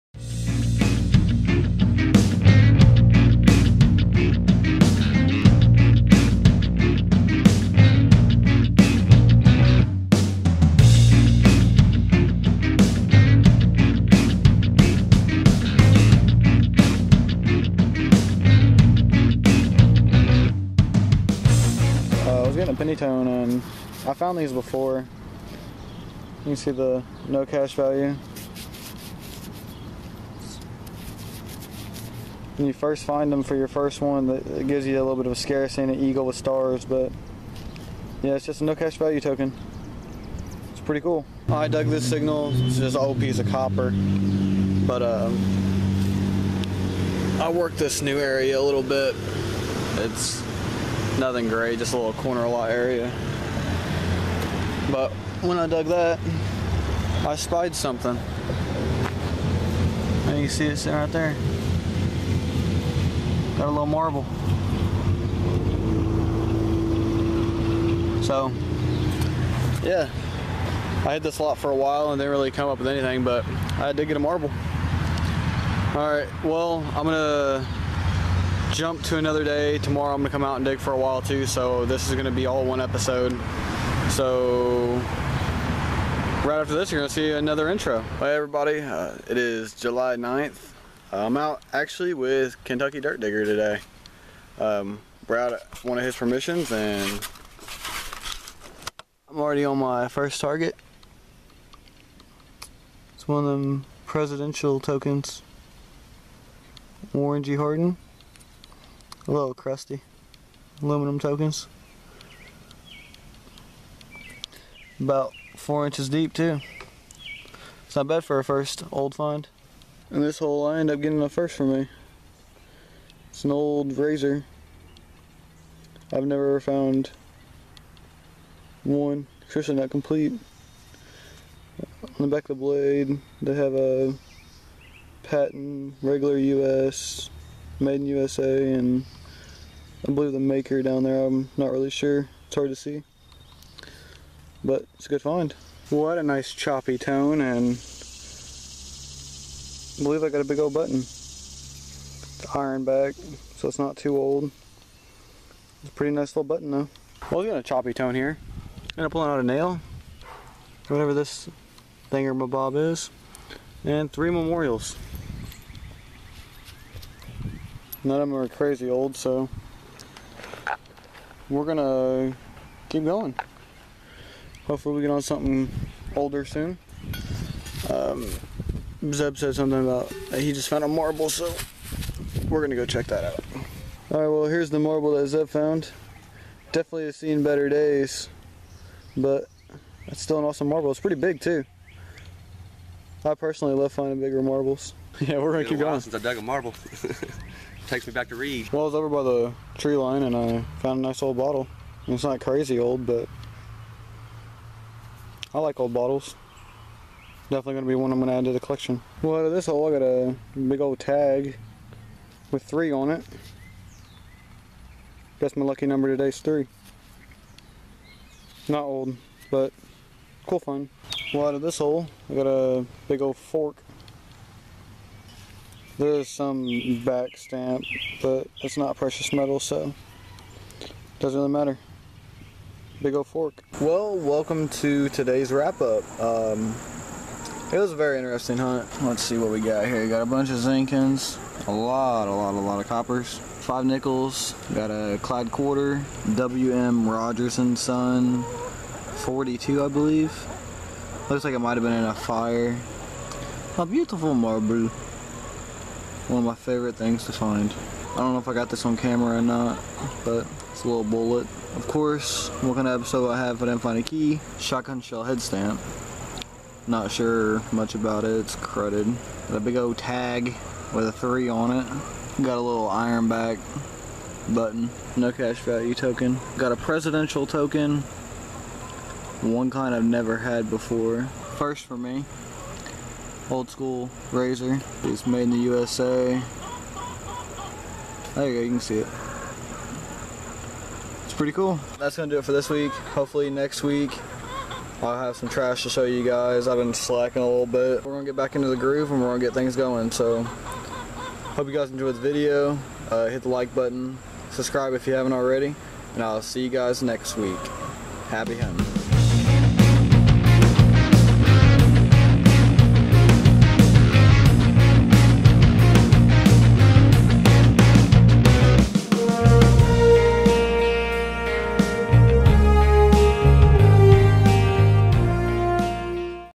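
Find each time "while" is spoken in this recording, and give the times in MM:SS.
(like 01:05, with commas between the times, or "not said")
01:11, 01:20.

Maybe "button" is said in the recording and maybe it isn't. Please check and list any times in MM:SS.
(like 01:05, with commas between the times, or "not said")
02:30, 02:36, 04:34, 05:03.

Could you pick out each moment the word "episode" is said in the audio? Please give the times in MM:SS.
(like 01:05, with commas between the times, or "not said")
01:22, 04:22.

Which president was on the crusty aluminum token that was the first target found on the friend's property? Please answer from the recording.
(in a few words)
Warren G. Harding.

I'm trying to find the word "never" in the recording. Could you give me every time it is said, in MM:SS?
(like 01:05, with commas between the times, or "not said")
02:06, 04:40.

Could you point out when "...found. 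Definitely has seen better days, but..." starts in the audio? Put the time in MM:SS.
03:05.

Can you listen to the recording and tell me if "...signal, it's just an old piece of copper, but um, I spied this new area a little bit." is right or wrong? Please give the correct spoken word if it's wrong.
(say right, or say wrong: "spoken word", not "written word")
wrong: "worked", not "spied".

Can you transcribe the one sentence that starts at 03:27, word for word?
Definitely gonna be one I'm gonna add to the collection.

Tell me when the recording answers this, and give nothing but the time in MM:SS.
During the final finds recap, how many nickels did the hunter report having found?
04:03.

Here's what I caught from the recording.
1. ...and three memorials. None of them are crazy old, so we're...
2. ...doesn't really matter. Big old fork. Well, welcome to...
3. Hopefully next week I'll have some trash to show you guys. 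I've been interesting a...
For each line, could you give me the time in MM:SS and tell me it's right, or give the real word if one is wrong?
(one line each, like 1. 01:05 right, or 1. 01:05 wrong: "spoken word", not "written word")
1. 02:43 right
2. 03:51 right
3. 04:52 wrong: "slacking", not "interesting".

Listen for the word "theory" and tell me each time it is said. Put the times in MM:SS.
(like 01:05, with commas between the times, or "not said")
not said.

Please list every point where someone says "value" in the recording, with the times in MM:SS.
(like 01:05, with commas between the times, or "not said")
00:27, 00:38, 04:35.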